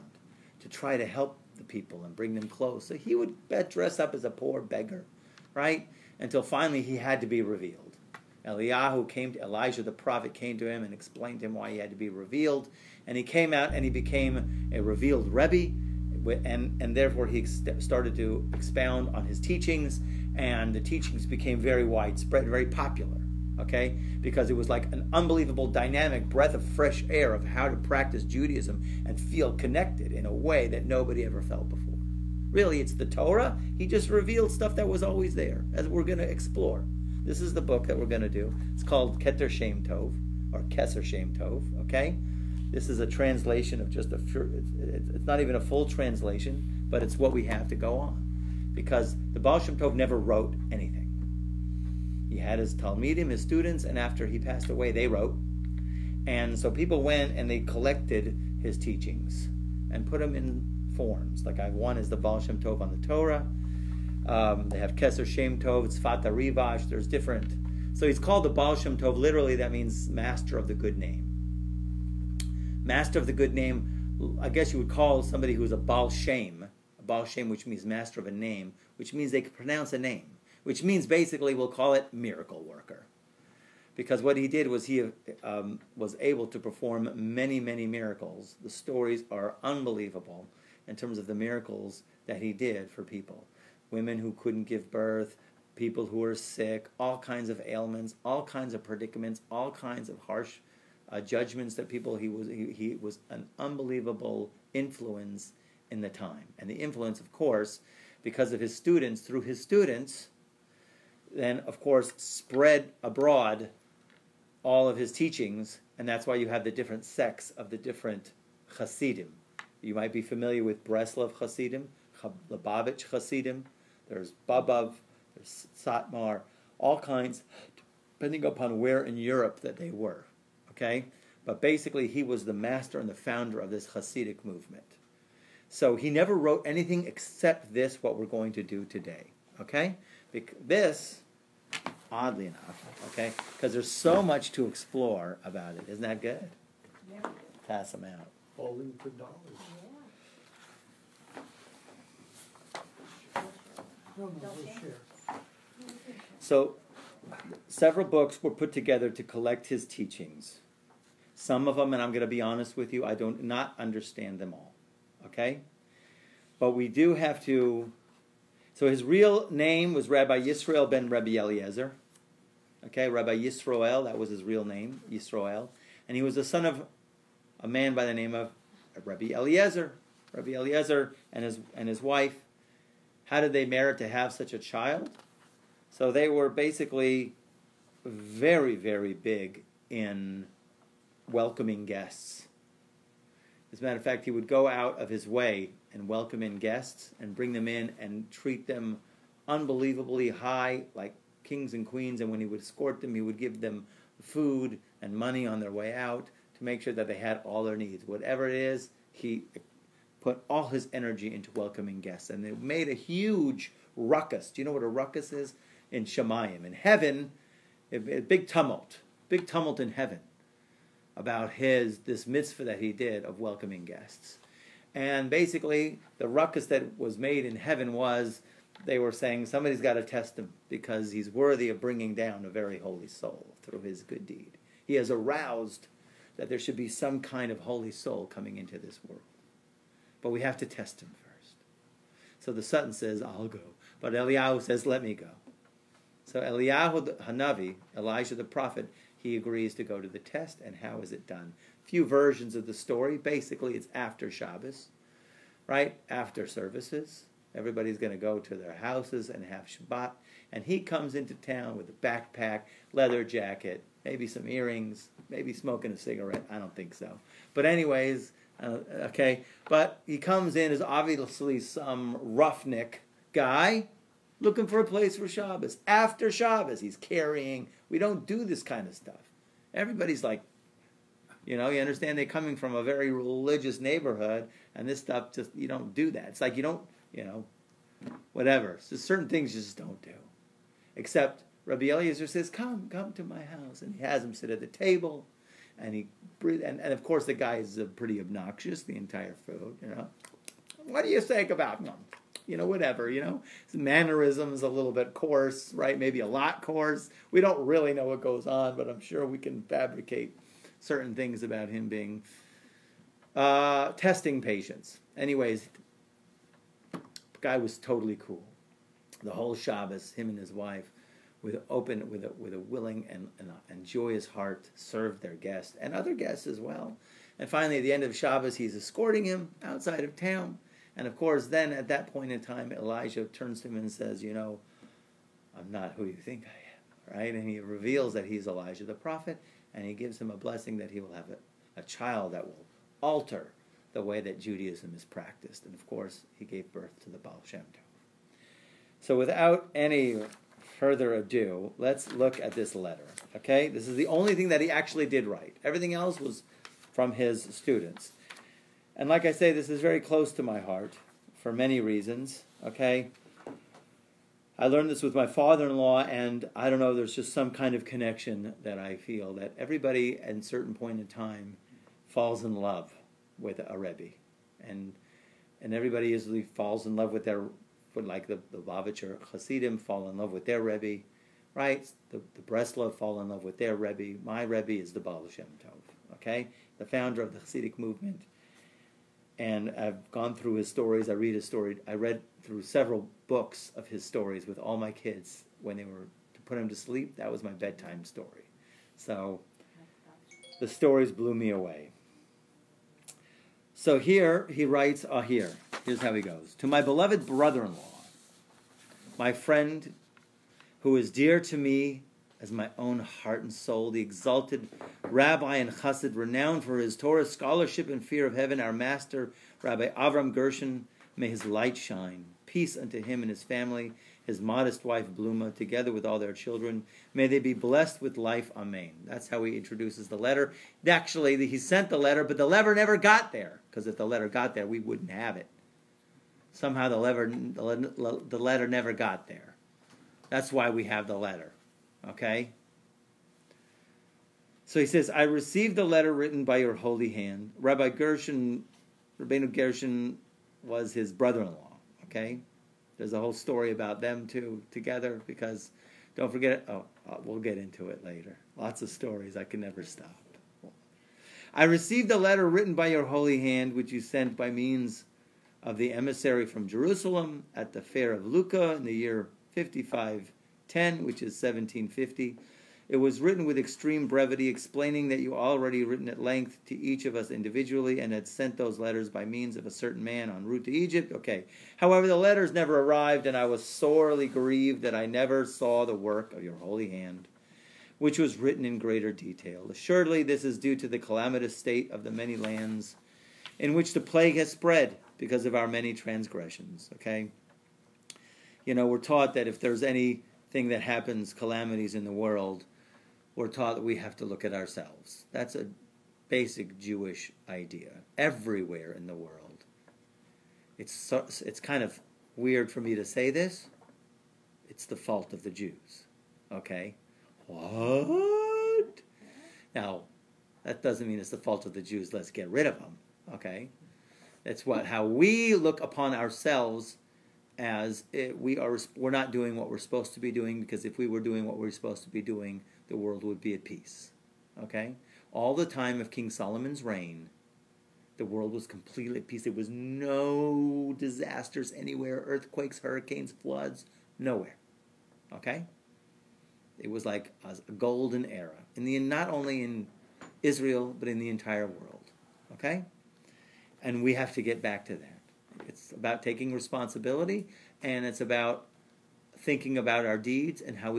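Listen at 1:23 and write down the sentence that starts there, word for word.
Because what he did was he um, was able to perform many, many miracles.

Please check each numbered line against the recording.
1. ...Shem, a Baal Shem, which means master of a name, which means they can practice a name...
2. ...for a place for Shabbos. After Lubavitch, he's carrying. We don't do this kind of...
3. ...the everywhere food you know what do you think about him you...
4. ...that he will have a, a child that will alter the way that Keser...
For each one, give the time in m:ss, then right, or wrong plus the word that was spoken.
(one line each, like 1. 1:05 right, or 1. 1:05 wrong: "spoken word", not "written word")
1. 1:16 wrong: "pronounce", not "practice"
2. 4:34 wrong: "Shabbos", not "Lubavitch"
3. 4:58 wrong: "entire", not "everywhere"
4. 5:40 wrong: "Judaism", not "Keser".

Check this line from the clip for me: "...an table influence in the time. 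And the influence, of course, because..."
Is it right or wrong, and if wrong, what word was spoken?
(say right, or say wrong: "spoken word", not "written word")
wrong: "unbelievable", not "table".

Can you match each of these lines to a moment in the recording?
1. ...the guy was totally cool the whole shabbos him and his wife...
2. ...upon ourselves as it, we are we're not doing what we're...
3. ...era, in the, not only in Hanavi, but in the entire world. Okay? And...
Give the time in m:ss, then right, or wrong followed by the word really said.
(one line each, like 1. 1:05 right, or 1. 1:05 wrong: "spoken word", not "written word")
1. 5:16 right
2. 8:45 right
3. 9:08 wrong: "Israel", not "Hanavi".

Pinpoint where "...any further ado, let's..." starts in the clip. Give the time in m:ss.
5:49.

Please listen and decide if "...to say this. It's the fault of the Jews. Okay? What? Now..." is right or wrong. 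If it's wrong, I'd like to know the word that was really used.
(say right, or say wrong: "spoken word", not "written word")
right.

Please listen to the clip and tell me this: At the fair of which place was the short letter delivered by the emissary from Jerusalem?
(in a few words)
Lucca.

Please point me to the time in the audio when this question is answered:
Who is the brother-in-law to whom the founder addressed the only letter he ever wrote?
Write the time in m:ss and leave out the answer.
6:59.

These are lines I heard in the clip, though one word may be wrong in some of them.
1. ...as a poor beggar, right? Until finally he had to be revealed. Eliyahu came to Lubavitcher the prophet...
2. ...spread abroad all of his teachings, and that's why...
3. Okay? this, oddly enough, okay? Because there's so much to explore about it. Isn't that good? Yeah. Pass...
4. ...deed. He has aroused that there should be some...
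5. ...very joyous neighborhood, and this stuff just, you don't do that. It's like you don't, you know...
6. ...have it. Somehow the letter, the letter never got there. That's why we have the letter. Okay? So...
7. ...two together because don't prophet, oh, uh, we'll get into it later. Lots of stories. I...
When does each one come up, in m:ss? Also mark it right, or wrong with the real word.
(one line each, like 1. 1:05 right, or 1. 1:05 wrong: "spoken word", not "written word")
1. 0:04 wrong: "Elijah", not "Lubavitcher"
2. 1:52 right
3. 2:19 right
4. 3:54 right
5. 4:42 wrong: "religious", not "joyous"
6. 7:15 right
7. 7:34 wrong: "forget", not "prophet".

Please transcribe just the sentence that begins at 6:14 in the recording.
And, and everybody usually falls in love with their like the, the Lubavitcher Hasidim fall in love with their Rebbe, right?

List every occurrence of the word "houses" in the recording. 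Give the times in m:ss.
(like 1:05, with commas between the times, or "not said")
4:18, 4:53.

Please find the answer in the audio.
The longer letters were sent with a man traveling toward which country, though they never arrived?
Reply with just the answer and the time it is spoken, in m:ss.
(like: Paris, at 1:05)
Egypt, at 8:00.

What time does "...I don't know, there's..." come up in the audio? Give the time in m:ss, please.
6:06.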